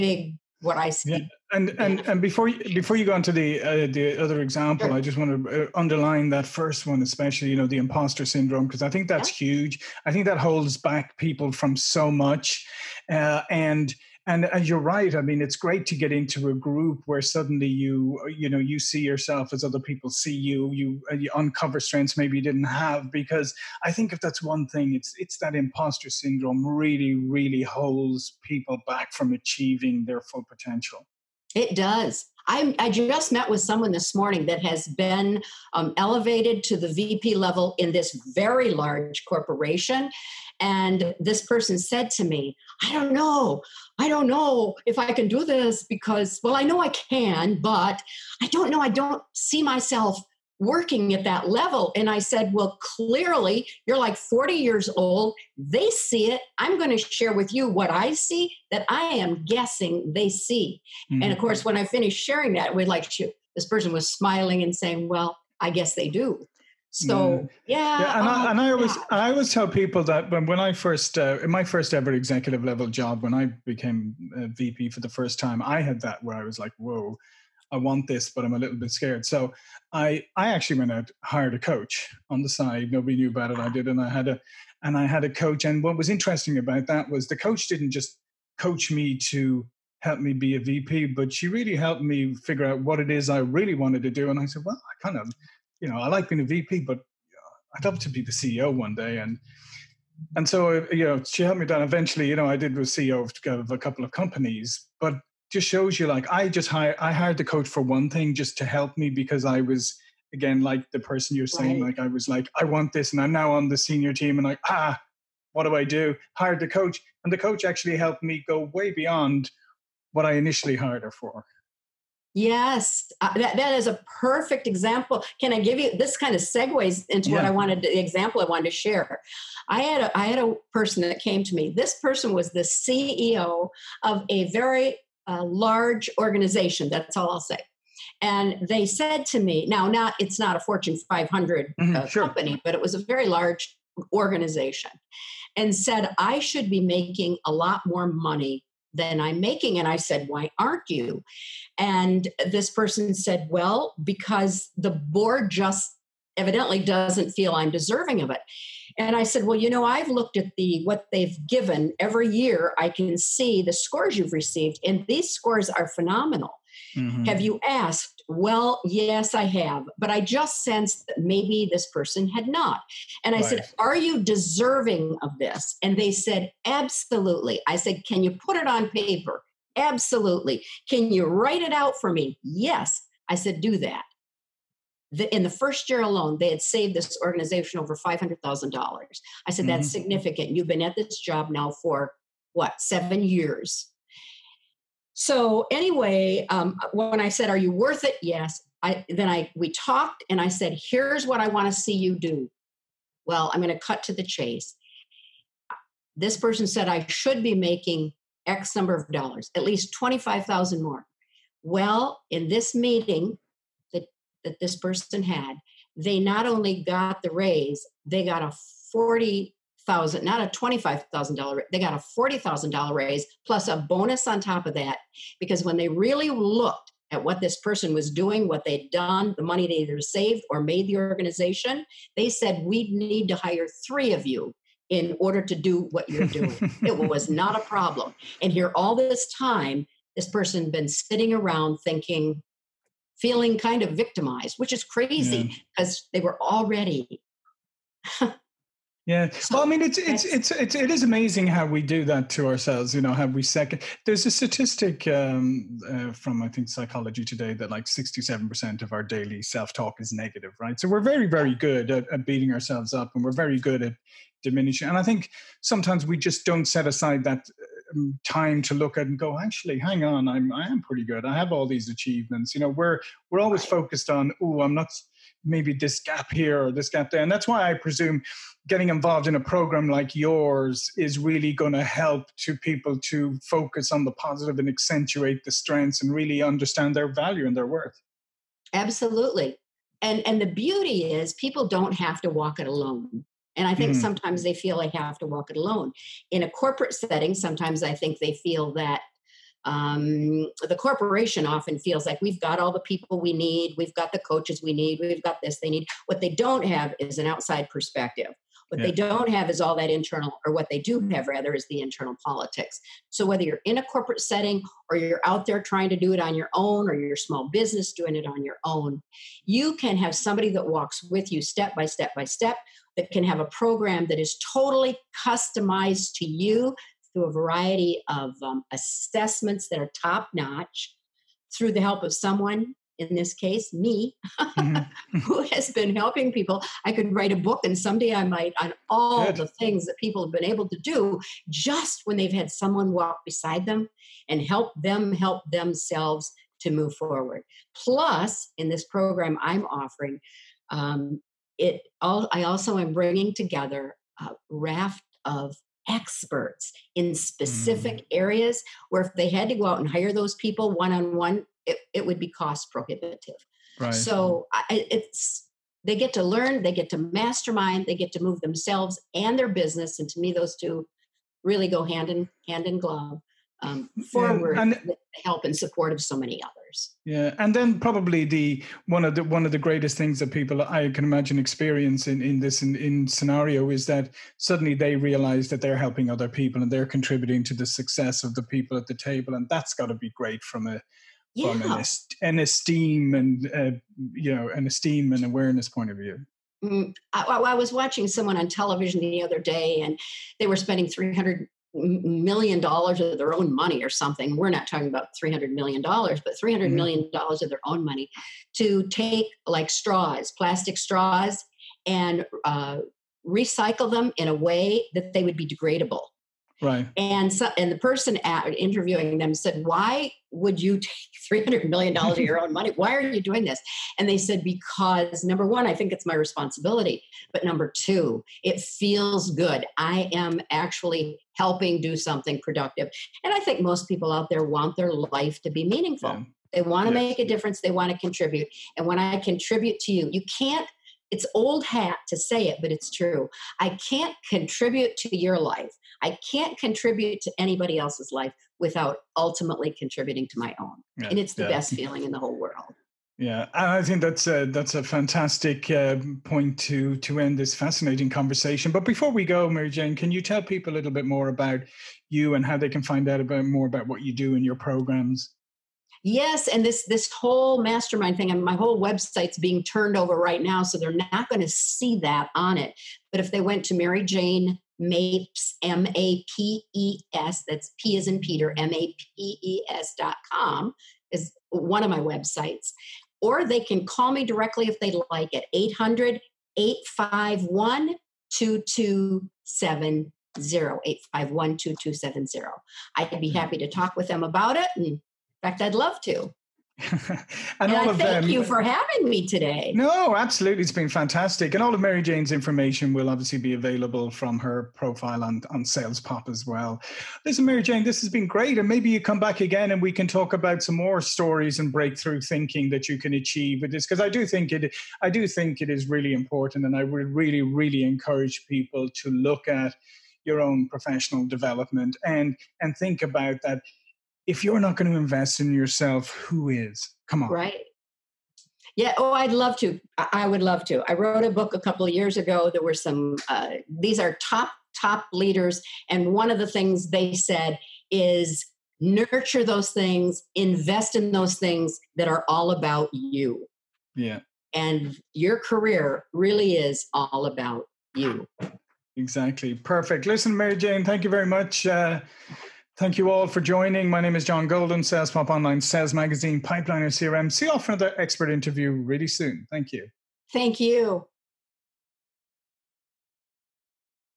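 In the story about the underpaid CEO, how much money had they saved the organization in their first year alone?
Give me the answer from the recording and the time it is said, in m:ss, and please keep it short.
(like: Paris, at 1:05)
$500,000, at 3:07.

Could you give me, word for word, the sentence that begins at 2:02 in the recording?
Yes, uh, that, that is a perfect example.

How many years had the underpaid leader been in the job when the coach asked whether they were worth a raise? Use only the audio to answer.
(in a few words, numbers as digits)
7.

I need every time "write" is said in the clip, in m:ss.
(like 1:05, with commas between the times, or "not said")
3:01, 5:37.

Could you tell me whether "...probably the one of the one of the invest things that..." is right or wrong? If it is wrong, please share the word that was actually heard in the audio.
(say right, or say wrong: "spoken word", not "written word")
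wrong: "greatest", not "invest".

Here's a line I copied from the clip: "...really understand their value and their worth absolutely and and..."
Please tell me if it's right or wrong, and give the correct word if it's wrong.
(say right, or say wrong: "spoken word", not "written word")
right.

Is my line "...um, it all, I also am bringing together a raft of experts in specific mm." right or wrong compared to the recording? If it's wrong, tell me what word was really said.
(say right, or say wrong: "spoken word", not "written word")
right.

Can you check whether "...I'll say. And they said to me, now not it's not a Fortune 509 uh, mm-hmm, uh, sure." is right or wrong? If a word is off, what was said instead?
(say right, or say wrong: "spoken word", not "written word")
wrong: "500", not "509".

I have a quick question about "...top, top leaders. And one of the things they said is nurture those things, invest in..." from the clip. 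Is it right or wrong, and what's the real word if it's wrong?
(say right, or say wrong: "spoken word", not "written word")
right.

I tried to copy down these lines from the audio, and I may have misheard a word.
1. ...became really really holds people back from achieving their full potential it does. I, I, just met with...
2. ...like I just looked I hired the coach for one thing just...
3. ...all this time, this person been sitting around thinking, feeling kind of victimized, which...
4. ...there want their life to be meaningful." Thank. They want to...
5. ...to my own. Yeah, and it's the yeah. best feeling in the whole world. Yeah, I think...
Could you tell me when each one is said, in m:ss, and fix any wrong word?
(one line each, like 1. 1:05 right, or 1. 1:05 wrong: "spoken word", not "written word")
1. 0:26 wrong: "syndrome", not "became"
2. 1:46 wrong: "hired", not "looked"
3. 3:58 right
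4. 7:14 wrong: "Yeah", not "Thank"
5. 7:30 right.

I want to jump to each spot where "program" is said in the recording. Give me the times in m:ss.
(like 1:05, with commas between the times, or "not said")
4:39, 5:23, 5:48, 7:44.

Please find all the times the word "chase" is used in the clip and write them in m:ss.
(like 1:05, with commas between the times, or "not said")
3:24.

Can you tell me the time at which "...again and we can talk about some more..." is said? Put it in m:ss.
8:29.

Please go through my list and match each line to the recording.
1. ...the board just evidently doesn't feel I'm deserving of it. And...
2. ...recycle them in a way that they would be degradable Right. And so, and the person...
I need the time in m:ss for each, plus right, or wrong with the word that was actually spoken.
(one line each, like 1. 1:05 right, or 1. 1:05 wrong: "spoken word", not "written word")
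1. 2:34 right
2. 6:53 right.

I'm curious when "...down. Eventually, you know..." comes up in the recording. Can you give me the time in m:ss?
1:41.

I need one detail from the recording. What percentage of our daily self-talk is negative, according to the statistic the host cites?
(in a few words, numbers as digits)
67%.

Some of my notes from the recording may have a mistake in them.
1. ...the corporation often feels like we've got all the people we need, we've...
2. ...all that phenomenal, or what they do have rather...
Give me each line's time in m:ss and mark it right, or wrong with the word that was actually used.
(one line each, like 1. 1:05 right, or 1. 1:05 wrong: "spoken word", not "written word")
1. 5:00 right
2. 5:09 wrong: "internal", not "phenomenal".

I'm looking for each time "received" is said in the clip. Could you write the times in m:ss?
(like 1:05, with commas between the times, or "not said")
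2:44.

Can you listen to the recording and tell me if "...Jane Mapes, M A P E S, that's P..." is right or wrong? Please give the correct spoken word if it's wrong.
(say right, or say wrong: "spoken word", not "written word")
right.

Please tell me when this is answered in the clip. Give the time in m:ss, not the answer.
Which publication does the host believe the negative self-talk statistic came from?
4:16.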